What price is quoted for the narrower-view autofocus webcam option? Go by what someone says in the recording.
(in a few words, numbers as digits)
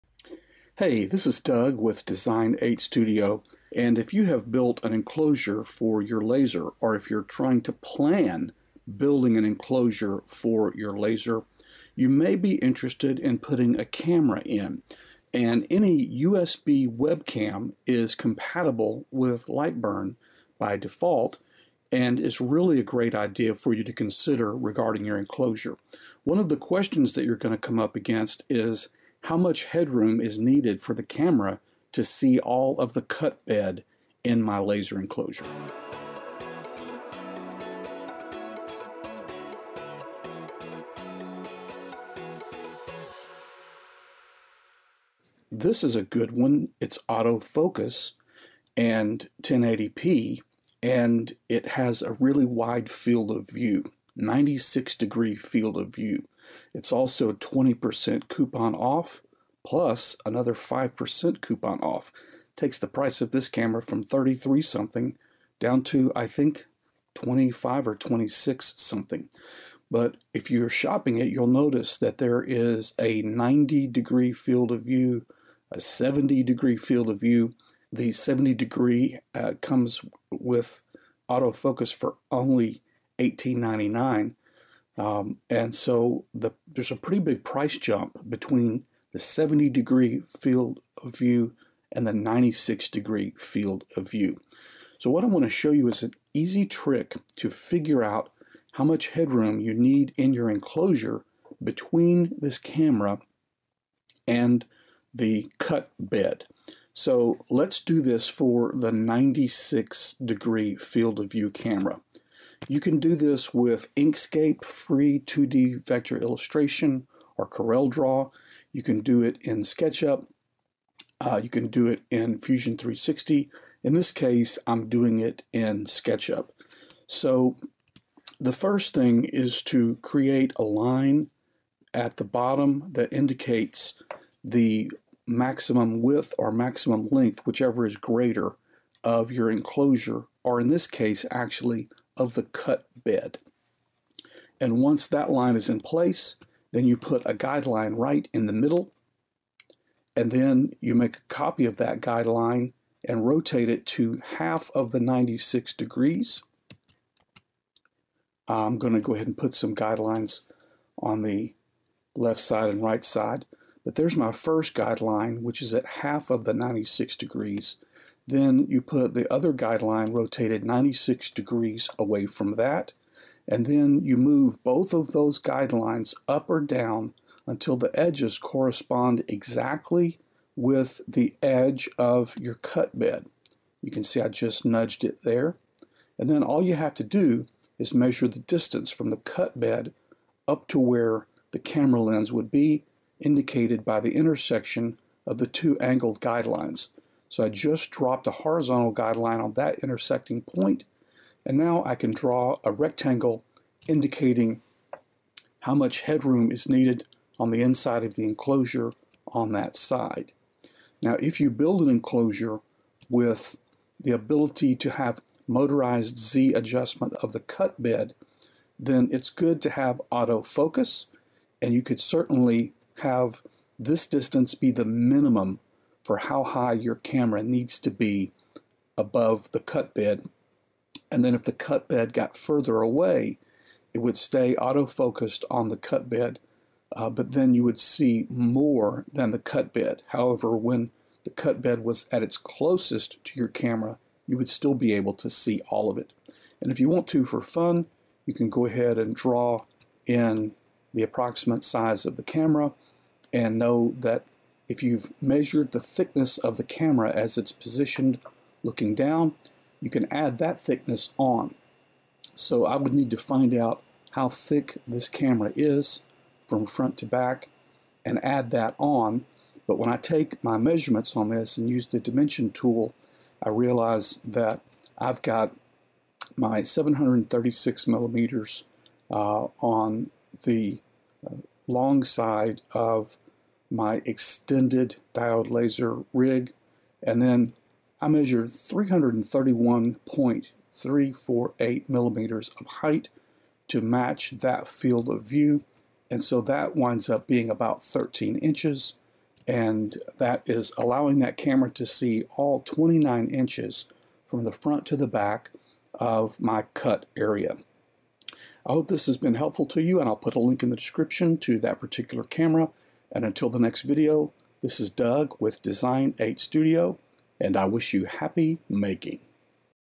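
$18.99.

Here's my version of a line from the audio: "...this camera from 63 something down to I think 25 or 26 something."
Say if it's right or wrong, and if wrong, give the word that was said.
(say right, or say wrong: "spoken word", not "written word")
wrong: "33", not "63".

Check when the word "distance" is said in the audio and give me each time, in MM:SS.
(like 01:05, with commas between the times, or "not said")
03:08, 03:44.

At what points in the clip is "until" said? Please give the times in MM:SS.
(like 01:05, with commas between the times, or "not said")
02:57, 05:13.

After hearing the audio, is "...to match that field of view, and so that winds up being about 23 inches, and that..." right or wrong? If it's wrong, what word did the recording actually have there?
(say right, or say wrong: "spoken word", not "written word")
wrong: "13", not "23".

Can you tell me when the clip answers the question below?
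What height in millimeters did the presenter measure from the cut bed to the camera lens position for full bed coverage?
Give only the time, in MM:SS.
04:48.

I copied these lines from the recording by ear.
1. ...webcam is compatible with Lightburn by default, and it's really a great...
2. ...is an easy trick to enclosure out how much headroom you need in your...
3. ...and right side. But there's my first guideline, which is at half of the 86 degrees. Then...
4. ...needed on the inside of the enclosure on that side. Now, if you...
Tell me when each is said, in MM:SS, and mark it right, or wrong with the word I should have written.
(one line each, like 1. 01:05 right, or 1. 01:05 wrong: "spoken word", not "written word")
1. 00:16 right
2. 01:35 wrong: "figure", not "enclosure"
3. 02:42 wrong: "96", not "86"
4. 03:26 right.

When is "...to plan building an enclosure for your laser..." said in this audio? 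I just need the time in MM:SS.
00:07.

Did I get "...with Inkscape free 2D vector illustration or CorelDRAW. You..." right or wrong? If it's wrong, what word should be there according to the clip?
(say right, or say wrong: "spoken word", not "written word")
right.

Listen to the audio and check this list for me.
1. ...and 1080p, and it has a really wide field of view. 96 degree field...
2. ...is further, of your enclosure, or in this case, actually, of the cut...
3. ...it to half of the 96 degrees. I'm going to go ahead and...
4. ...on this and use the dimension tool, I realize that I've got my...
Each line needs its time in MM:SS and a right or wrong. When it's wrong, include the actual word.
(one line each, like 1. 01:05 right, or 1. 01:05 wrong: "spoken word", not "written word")
1. 00:48 right
2. 02:17 wrong: "greater", not "further"
3. 02:33 right
4. 04:31 right.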